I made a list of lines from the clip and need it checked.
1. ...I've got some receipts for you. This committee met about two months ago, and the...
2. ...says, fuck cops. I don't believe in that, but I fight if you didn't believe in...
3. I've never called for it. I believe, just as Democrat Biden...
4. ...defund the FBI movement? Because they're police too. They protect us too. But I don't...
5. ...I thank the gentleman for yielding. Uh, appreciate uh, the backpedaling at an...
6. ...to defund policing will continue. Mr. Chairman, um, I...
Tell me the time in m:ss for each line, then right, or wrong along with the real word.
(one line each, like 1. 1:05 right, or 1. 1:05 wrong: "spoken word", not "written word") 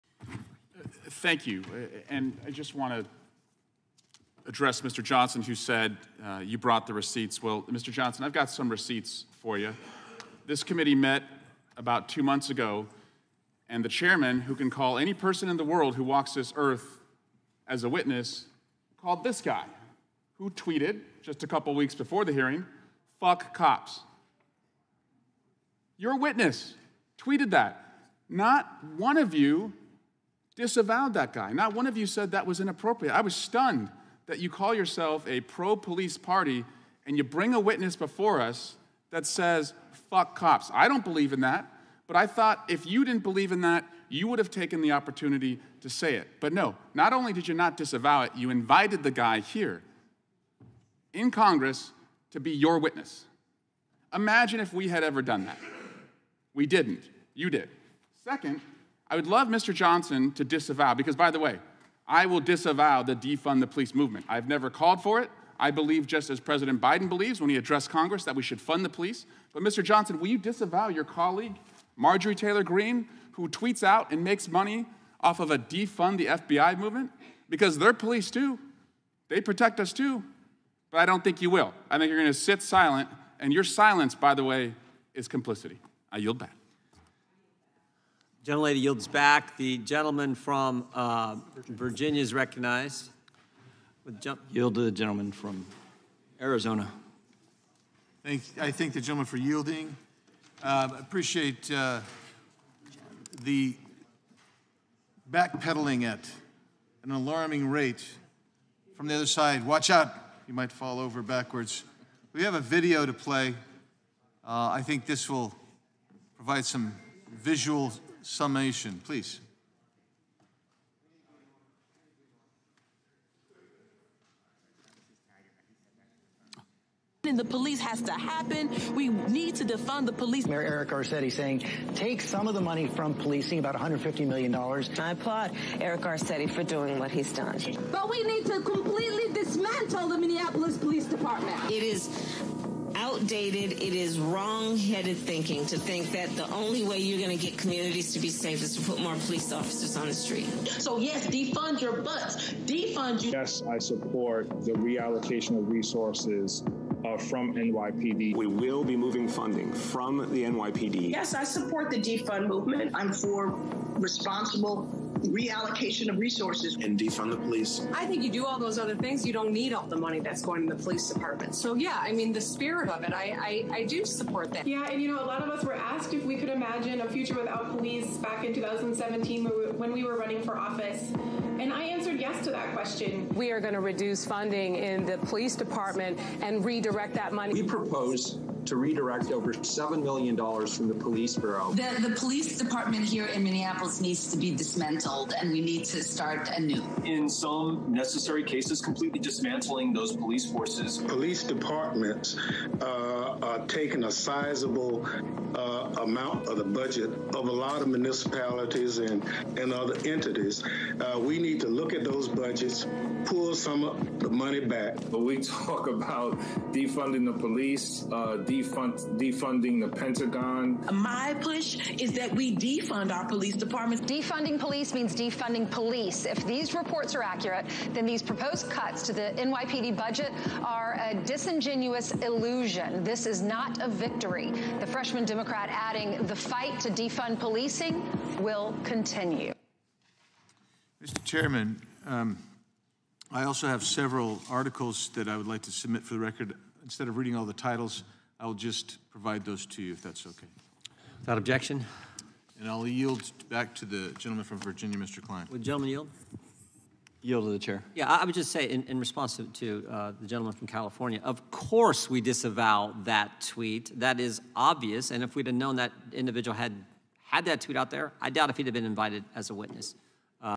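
1. 0:08 right
2. 0:39 wrong: "thought", not "fight"
3. 1:04 wrong: "President", not "Democrat"
4. 1:15 right
5. 1:38 right
6. 3:56 right.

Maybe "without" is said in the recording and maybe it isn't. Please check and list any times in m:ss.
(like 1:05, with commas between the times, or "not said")
2:57, 4:11.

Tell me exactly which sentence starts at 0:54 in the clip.
Imagine if we had ever done that.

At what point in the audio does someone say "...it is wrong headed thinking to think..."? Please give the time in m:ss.
2:23.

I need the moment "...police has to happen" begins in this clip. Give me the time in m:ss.
2:07.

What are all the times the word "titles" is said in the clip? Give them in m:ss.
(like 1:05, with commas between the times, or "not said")
4:07.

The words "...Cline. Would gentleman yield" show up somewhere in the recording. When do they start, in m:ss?
4:15.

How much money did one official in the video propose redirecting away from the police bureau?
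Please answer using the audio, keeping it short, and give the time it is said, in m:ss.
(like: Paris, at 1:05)
Over $7 million, at 3:09.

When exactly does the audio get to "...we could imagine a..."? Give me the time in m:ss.
2:56.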